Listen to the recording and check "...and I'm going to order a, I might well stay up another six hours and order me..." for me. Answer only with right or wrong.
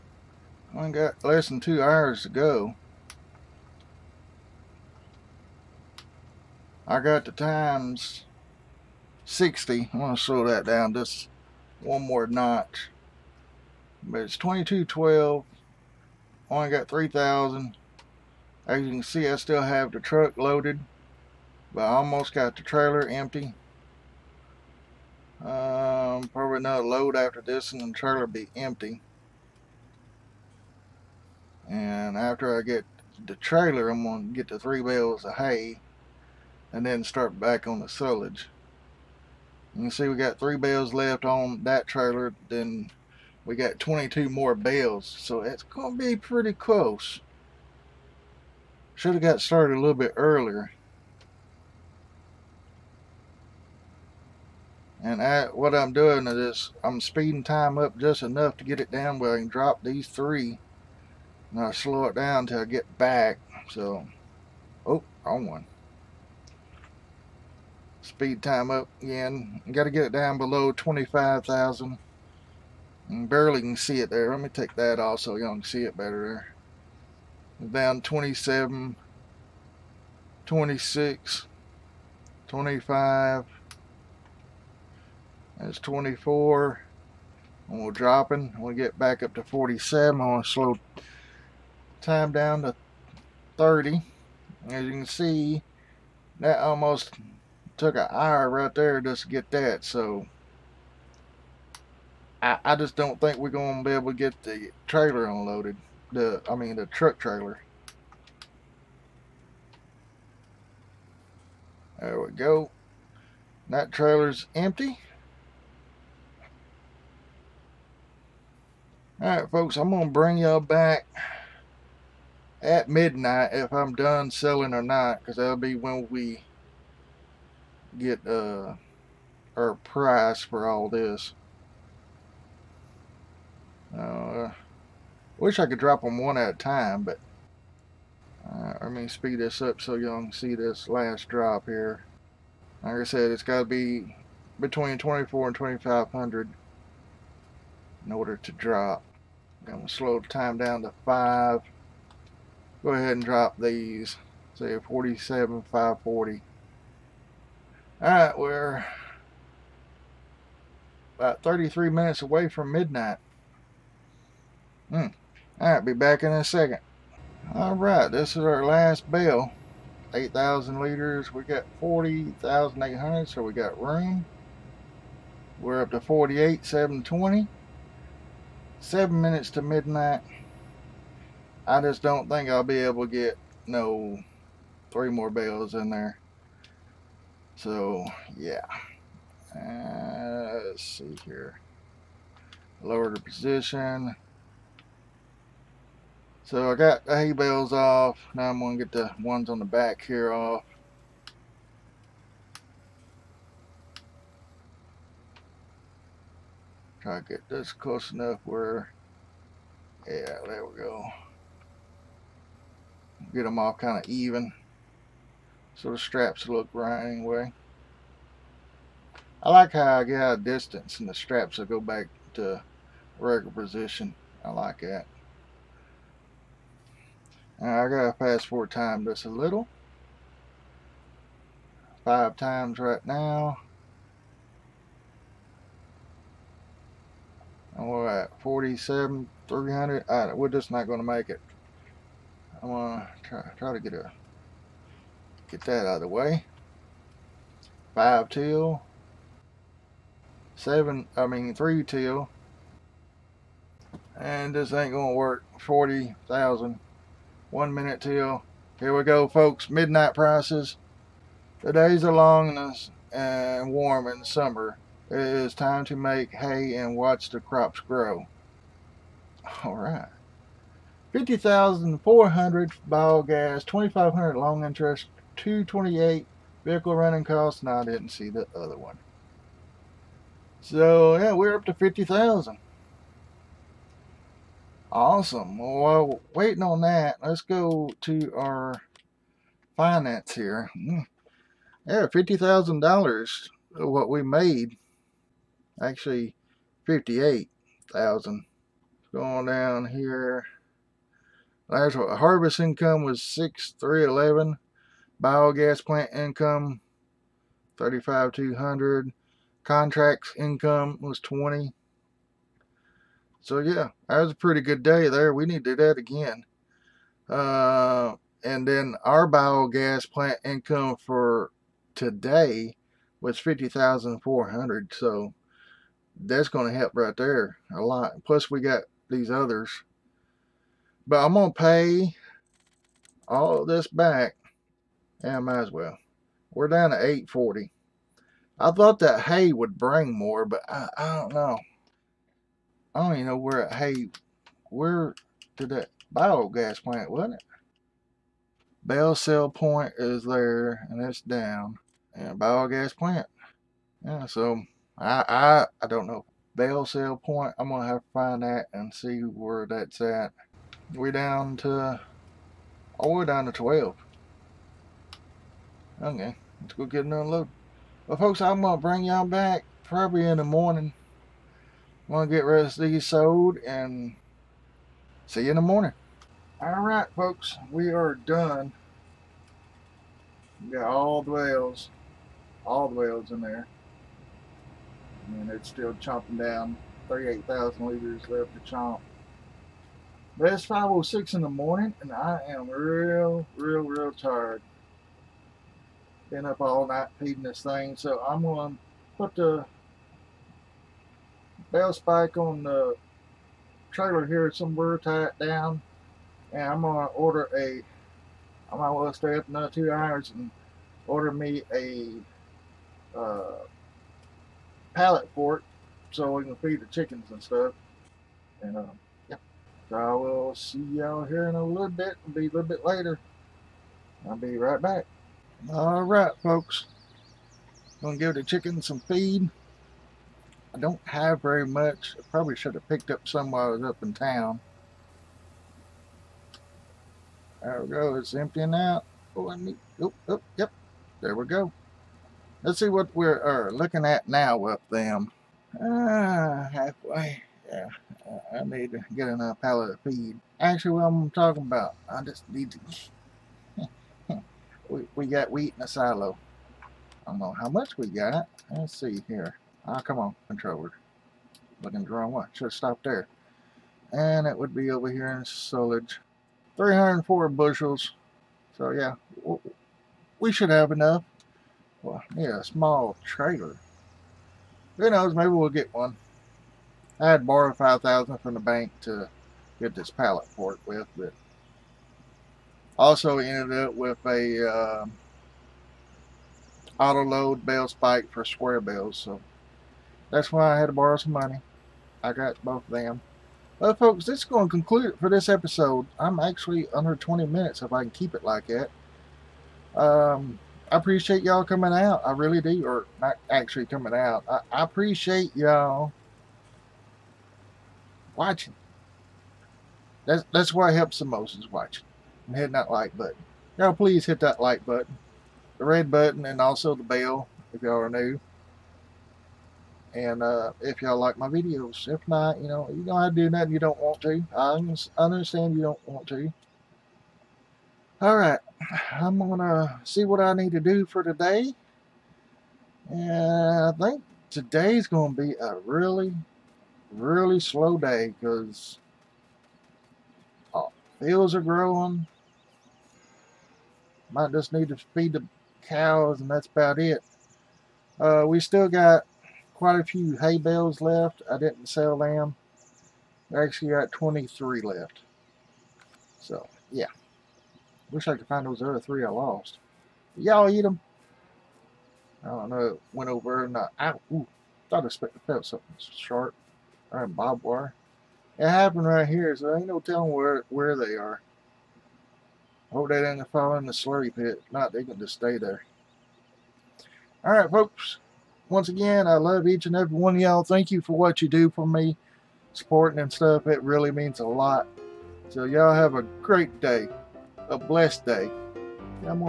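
wrong.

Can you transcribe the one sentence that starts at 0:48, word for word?
Should have got started a little bit earlier.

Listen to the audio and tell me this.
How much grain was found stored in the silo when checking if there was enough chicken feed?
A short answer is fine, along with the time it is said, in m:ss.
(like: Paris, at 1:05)
304 bushels, at 7:46.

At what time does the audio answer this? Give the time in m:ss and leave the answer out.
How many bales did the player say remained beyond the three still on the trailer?
0:43.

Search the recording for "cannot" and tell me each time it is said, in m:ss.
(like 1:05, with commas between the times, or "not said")
not said.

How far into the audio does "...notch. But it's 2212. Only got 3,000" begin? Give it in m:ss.
0:12.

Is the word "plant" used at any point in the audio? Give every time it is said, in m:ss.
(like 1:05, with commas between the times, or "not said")
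5:05, 5:20, 5:46, 5:52.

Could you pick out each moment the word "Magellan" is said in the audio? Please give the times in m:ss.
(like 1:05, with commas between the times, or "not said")
not said.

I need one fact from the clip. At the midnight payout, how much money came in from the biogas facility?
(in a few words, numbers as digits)
50,400.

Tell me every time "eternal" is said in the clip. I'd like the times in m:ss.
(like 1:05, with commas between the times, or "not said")
not said.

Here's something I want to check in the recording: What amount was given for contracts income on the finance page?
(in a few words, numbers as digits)
20.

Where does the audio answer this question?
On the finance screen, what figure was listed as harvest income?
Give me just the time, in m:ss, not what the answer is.
5:03.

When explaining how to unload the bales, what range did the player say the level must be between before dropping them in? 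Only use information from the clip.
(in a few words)
24 and 2500.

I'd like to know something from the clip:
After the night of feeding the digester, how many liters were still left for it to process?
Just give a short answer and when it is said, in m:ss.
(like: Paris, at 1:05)
38,000, at 6:27.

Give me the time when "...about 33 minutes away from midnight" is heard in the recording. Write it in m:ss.
2:41.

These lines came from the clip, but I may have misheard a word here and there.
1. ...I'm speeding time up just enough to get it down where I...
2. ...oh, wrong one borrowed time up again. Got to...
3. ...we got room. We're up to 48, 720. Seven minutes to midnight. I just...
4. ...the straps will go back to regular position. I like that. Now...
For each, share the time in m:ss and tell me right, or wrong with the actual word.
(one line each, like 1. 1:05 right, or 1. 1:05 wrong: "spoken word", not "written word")
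1. 0:56 right
2. 1:04 wrong: "speed", not "borrowed"
3. 2:53 right
4. 3:41 right.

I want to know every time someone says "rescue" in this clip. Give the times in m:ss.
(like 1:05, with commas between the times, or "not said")
not said.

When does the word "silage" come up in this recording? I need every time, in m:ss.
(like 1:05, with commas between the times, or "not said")
0:37, 7:45.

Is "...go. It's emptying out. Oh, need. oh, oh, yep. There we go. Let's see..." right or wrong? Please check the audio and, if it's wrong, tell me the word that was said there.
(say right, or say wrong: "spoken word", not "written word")
right.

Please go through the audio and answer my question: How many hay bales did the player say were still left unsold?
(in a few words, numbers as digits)
23.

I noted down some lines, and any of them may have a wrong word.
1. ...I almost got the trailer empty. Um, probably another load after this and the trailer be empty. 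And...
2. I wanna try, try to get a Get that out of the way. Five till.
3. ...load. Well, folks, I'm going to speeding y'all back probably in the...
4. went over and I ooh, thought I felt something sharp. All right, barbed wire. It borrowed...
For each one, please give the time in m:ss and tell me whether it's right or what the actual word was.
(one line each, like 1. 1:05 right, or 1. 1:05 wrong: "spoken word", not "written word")
1. 0:21 right
2. 4:02 right
3. 6:07 wrong: "bring", not "speeding"
4. 9:23 wrong: "happened", not "borrowed".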